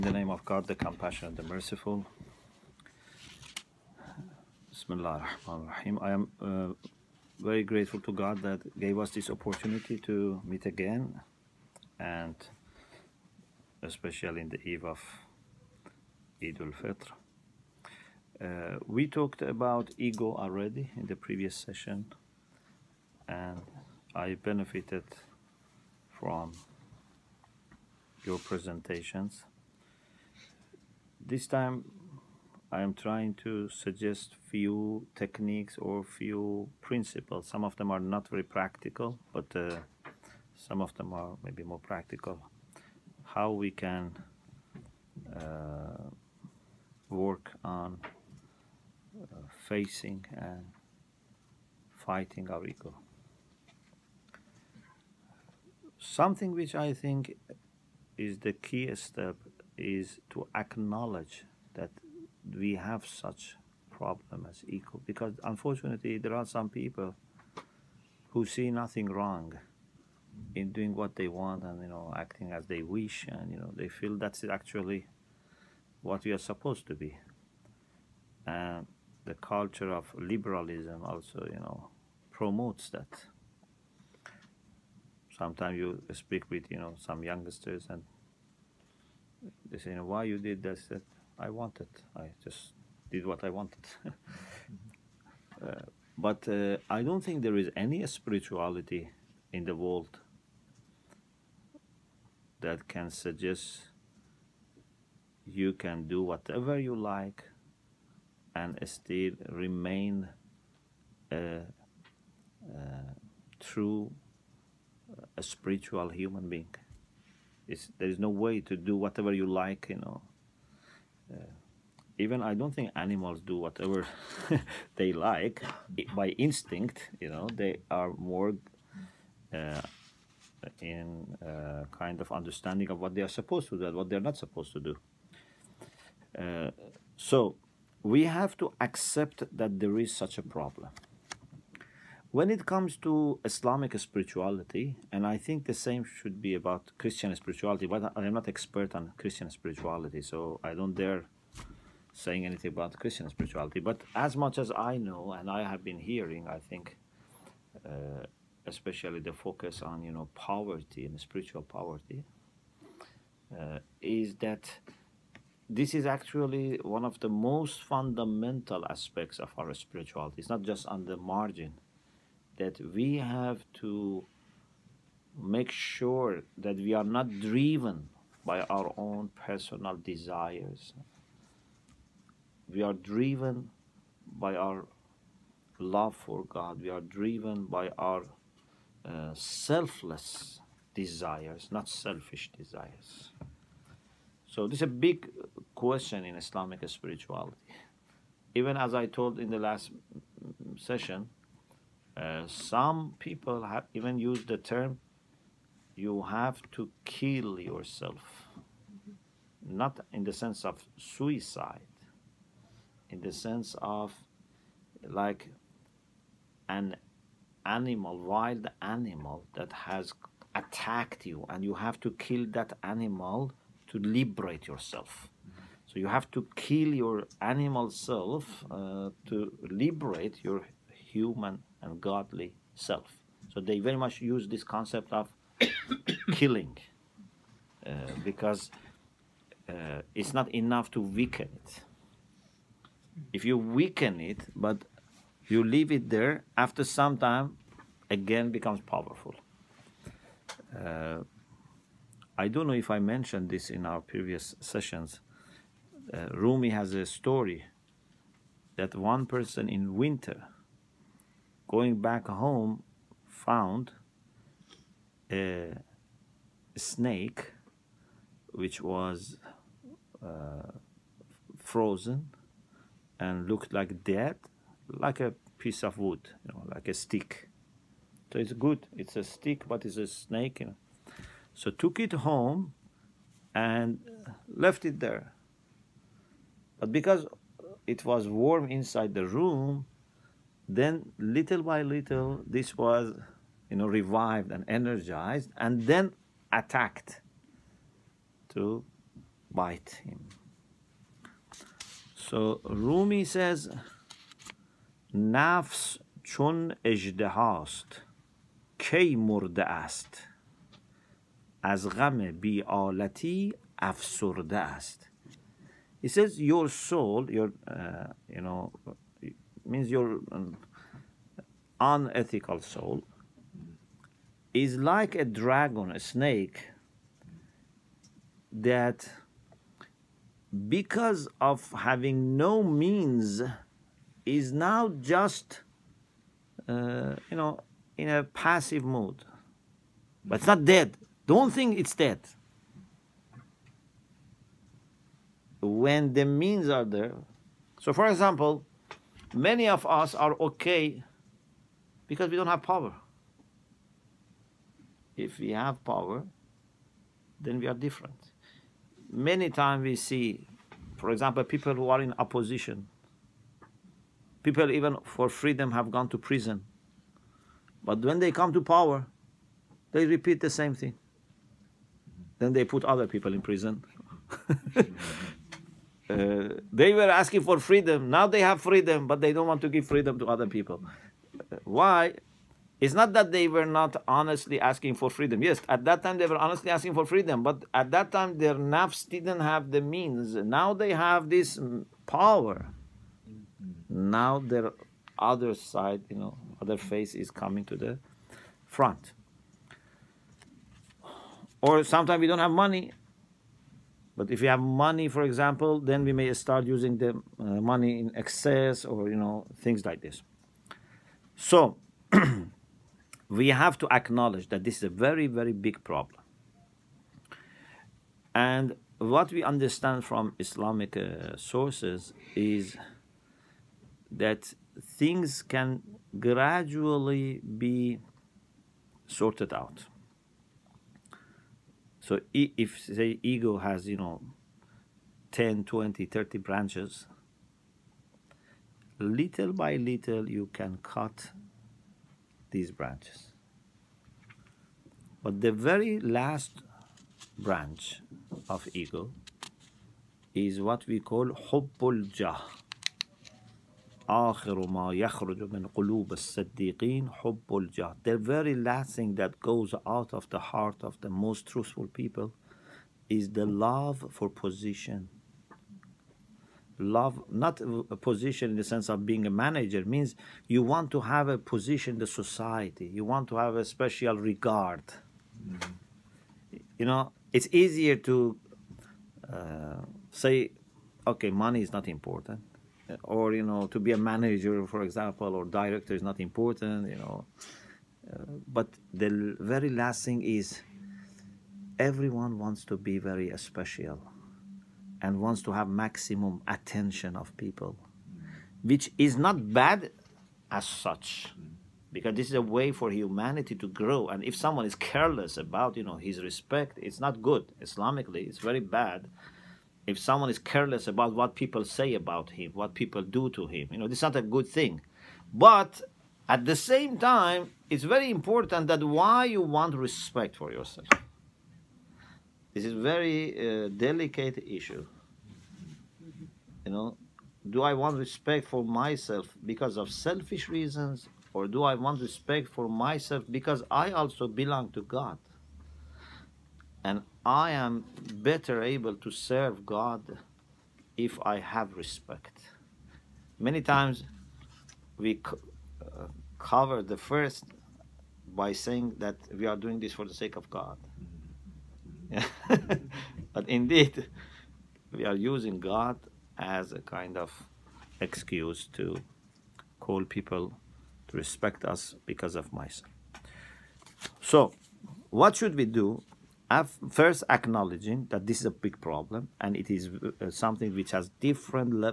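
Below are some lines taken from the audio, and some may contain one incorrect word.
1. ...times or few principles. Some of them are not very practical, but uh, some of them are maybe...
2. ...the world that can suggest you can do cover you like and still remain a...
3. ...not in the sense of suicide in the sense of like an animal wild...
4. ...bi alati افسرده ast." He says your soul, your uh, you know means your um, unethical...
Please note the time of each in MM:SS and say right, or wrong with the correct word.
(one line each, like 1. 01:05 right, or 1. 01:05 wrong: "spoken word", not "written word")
1. 00:35 wrong: "techniques", not "times"
2. 01:39 wrong: "whatever", not "cover"
3. 03:29 right
4. 05:12 right.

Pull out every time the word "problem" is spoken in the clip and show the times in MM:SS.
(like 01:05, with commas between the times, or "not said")
01:03, 02:20, 06:55, 09:28.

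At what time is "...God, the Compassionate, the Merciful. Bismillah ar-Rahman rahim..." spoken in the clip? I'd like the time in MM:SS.
00:00.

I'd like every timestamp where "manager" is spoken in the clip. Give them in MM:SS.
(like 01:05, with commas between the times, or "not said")
07:49, 08:03.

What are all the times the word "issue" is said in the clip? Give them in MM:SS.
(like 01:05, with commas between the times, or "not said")
08:44.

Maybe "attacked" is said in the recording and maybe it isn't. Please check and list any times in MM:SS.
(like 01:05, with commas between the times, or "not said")
03:40, 04:56.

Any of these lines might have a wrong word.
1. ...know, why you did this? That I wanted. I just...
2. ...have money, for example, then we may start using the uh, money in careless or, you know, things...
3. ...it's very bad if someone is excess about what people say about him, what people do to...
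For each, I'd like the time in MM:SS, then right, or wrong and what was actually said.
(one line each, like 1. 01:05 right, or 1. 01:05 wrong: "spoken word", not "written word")
1. 01:29 right
2. 06:44 wrong: "excess", not "careless"
3. 08:28 wrong: "careless", not "excess".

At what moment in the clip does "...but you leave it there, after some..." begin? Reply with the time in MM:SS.
04:04.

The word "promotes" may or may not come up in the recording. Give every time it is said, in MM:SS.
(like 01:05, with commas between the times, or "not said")
01:22.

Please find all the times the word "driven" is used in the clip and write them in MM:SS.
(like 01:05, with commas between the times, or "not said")
02:57, 03:02, 03:07.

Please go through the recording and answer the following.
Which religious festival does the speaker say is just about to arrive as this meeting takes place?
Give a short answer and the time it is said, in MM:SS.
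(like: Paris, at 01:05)
Eid al-Fitr, at 00:16.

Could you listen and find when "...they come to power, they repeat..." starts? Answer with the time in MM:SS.
06:08.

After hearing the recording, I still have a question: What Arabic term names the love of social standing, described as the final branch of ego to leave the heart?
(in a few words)
hubbul jah.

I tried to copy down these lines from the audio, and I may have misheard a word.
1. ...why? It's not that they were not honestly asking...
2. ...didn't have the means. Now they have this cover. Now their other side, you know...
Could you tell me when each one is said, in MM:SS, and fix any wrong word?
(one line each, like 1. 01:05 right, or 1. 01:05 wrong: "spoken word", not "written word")
1. 06:21 right
2. 06:29 wrong: "power", not "cover".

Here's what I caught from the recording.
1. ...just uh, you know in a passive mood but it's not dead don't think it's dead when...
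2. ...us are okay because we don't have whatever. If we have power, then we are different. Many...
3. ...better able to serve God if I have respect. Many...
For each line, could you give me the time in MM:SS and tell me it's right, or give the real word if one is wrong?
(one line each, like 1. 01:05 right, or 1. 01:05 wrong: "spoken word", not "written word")
1. 05:35 right
2. 05:49 wrong: "power", not "whatever"
3. 08:58 right.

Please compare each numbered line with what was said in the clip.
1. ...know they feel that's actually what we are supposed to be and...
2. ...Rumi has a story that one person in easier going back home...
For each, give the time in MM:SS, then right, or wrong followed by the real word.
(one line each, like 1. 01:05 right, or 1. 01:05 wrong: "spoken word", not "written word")
1. 01:13 right
2. 04:16 wrong: "winter", not "easier".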